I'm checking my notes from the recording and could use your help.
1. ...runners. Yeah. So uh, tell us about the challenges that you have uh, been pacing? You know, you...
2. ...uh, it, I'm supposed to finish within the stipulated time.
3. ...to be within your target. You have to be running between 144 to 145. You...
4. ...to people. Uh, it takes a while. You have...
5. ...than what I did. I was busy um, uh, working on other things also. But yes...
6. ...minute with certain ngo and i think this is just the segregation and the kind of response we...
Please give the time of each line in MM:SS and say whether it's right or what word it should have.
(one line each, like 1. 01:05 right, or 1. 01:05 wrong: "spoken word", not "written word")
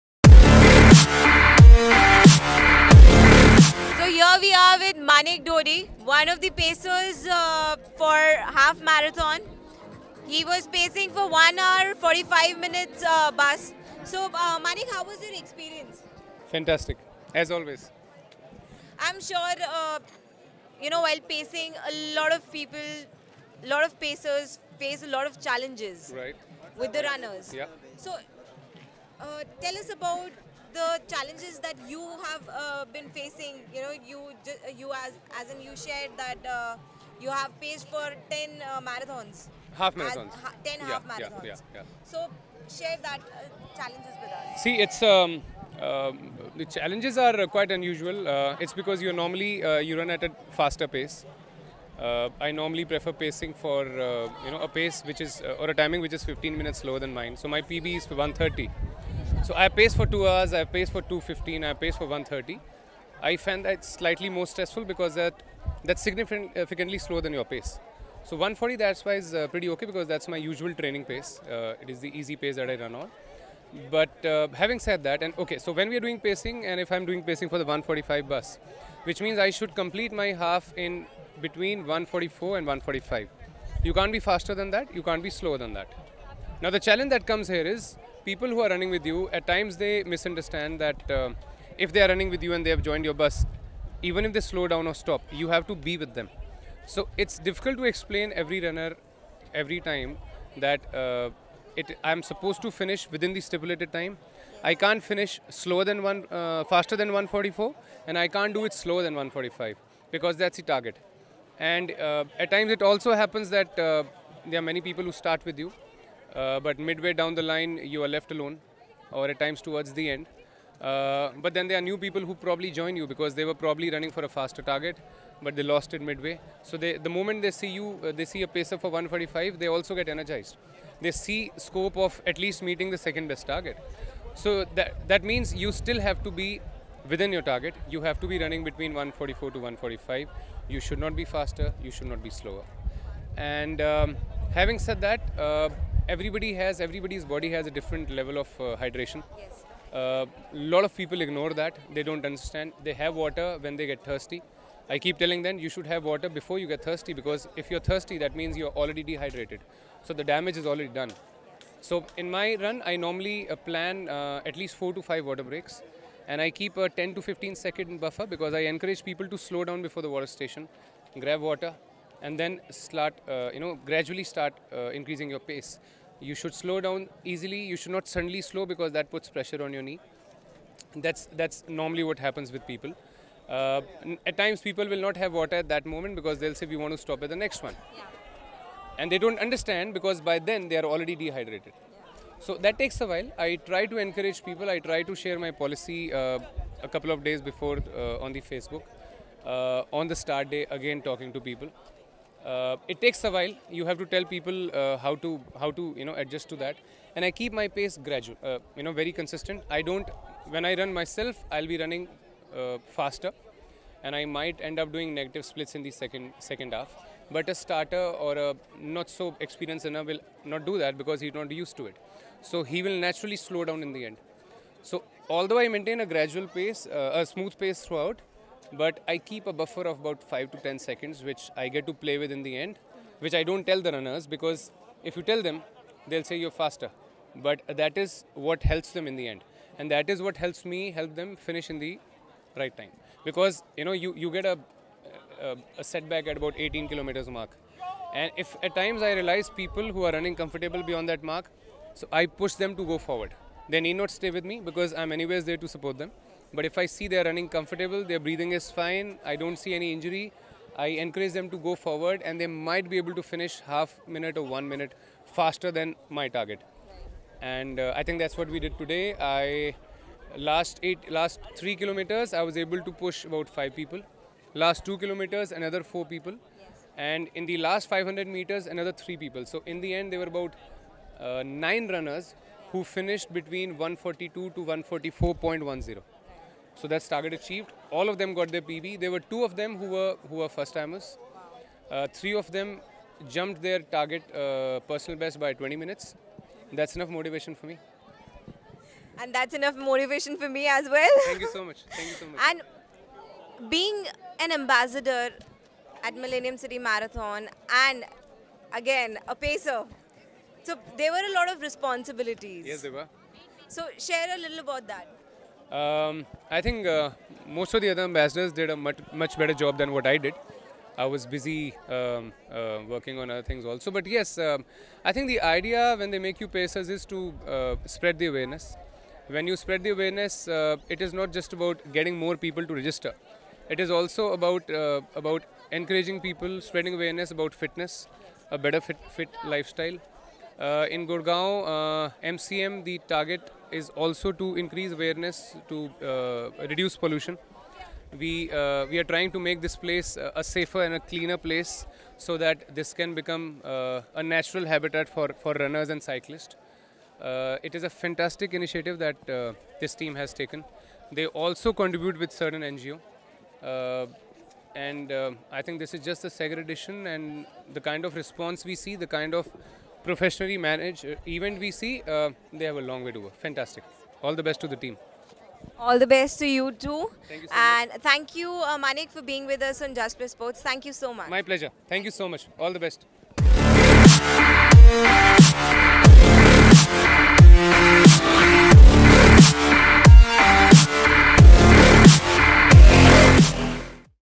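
1. 00:27 wrong: "facing", not "pacing"
2. 01:40 right
3. 02:16 right
4. 03:21 right
5. 05:19 right
6. 06:01 wrong: "contribute", not "minute".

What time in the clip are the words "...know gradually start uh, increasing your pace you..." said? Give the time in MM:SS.
02:53.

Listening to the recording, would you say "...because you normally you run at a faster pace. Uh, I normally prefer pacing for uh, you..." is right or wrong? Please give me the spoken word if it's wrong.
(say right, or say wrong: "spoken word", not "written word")
right.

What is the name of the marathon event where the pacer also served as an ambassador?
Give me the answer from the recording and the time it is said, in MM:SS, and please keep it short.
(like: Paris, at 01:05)
Millennium City Marathon, at 05:06.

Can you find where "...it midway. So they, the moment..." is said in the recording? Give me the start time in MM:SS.
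02:05.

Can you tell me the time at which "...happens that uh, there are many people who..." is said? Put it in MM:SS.
01:53.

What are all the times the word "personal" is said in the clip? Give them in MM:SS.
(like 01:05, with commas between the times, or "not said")
04:54.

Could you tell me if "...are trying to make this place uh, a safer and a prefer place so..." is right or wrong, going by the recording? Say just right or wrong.
wrong.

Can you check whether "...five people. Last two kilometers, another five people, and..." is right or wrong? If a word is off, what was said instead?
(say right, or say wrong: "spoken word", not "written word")
wrong: "four", not "five".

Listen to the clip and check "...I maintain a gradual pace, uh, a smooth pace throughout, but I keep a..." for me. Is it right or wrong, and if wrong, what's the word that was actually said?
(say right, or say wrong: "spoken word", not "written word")
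right.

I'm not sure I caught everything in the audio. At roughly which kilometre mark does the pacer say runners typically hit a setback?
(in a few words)
18.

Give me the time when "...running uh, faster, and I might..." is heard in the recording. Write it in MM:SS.
03:31.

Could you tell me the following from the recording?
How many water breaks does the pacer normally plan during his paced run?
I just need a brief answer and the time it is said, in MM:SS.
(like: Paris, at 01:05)
4 to 5, at 02:44.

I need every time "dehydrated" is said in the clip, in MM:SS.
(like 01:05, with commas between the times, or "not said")
02:39, 03:11.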